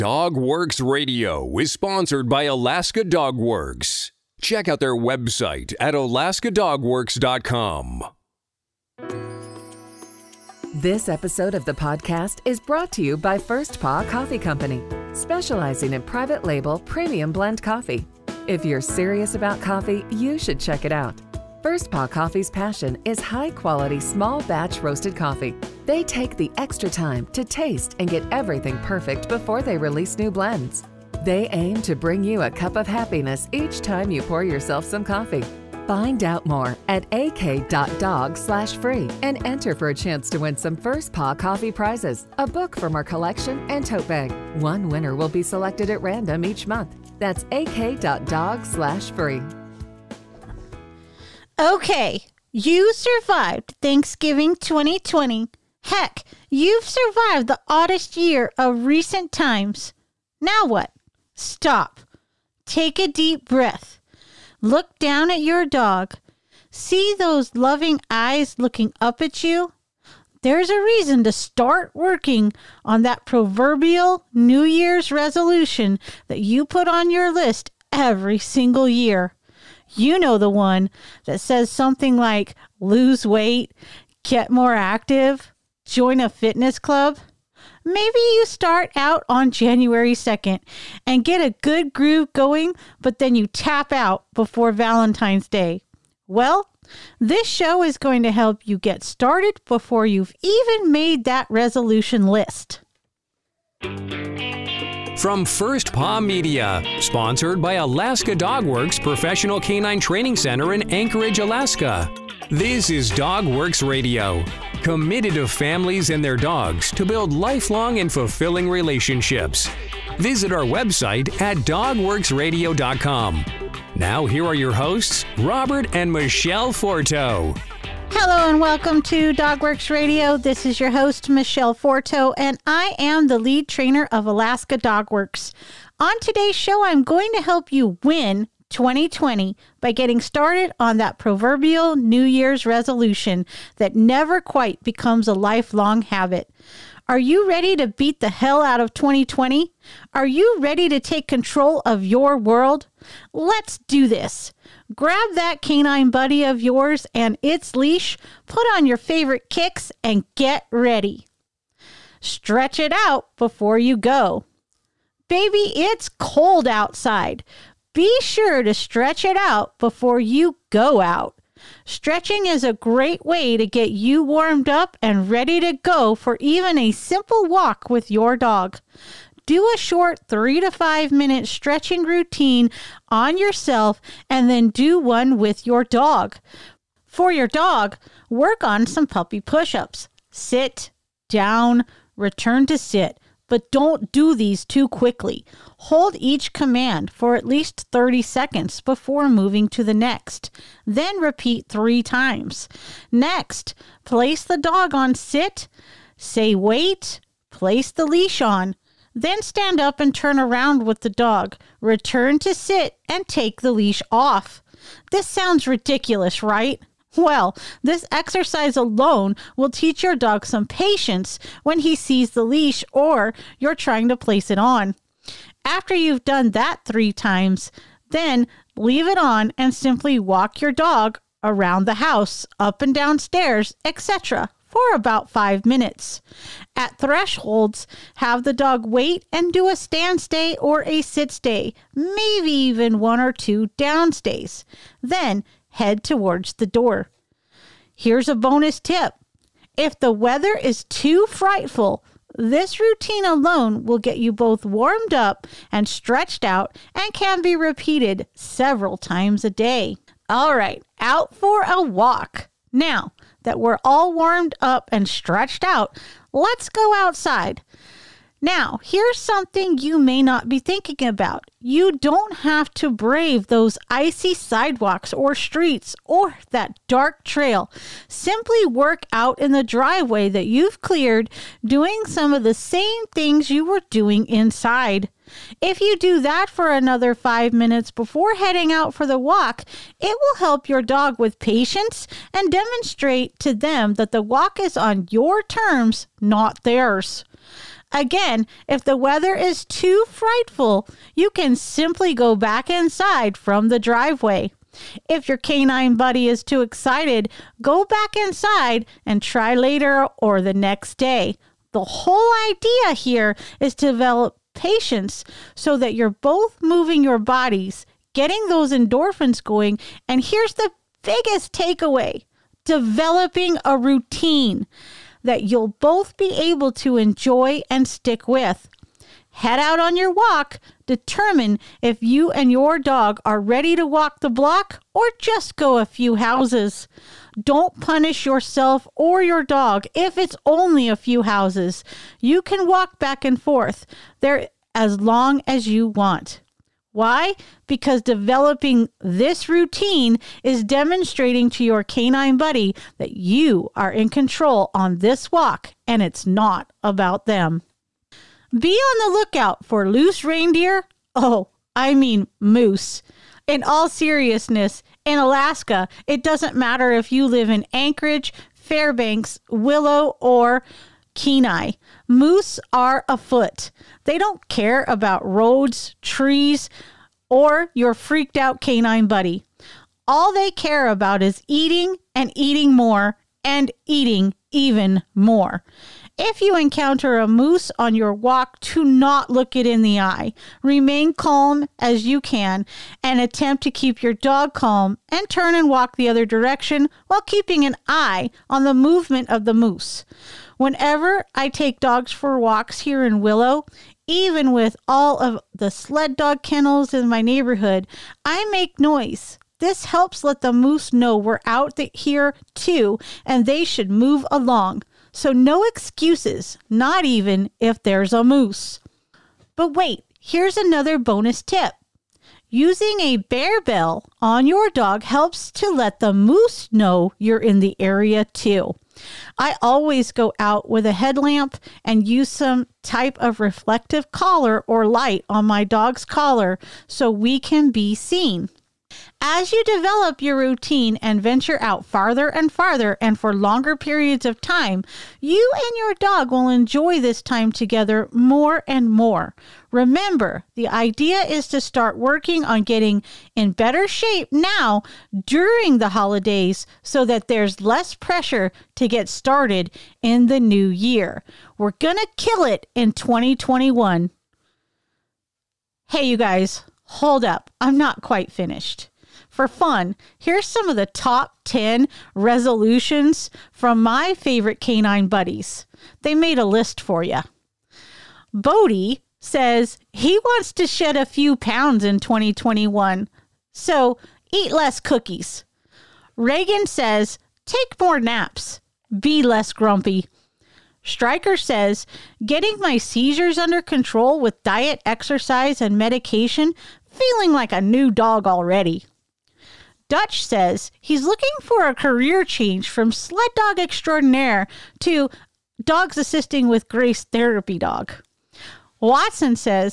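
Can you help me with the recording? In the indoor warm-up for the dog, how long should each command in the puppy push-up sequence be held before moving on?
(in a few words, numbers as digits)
30 seconds.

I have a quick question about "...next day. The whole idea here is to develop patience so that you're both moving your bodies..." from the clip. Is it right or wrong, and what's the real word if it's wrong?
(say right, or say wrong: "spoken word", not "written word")
right.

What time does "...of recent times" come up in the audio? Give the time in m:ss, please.
0:58.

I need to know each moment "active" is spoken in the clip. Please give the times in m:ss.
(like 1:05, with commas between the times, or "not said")
1:24.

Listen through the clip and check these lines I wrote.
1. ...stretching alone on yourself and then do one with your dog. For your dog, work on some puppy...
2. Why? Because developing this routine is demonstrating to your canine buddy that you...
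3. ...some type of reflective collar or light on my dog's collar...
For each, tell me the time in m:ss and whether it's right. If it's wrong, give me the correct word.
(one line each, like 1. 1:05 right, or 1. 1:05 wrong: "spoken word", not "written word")
1. 3:01 wrong: "routine", not "alone"
2. 5:46 right
3. 7:12 right.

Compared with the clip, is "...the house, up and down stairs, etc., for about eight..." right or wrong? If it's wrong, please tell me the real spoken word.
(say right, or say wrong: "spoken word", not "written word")
wrong: "five", not "eight".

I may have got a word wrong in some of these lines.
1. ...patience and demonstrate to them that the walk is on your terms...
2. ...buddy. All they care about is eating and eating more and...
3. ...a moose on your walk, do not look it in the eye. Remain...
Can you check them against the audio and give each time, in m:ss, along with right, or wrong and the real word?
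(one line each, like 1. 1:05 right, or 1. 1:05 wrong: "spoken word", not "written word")
1. 4:51 right
2. 6:19 right
3. 6:27 right.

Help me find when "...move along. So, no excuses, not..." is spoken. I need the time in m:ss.
6:53.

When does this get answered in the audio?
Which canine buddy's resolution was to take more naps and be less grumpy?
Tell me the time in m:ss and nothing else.
8:06.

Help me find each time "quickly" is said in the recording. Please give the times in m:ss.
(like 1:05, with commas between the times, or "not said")
3:14.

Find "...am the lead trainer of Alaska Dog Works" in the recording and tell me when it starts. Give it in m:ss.
2:12.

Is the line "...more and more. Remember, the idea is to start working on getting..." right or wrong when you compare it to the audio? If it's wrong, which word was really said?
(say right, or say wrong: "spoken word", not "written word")
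right.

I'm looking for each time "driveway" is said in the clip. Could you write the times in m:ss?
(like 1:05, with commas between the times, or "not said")
4:39, 5:03.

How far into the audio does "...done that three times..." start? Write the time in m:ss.
3:46.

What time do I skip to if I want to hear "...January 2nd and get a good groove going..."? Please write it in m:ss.
1:29.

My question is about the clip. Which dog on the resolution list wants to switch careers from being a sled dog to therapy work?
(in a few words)
Dutch.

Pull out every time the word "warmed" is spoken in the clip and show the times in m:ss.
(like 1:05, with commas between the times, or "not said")
2:54, 4:14, 4:24.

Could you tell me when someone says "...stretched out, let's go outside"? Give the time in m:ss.
4:25.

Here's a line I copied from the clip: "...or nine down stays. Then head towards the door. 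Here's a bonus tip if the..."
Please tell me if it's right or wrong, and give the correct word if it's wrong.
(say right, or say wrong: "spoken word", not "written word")
wrong: "two", not "nine".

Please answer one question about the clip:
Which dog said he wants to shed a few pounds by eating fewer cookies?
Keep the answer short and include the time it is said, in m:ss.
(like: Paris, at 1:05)
Bodie, at 7:58.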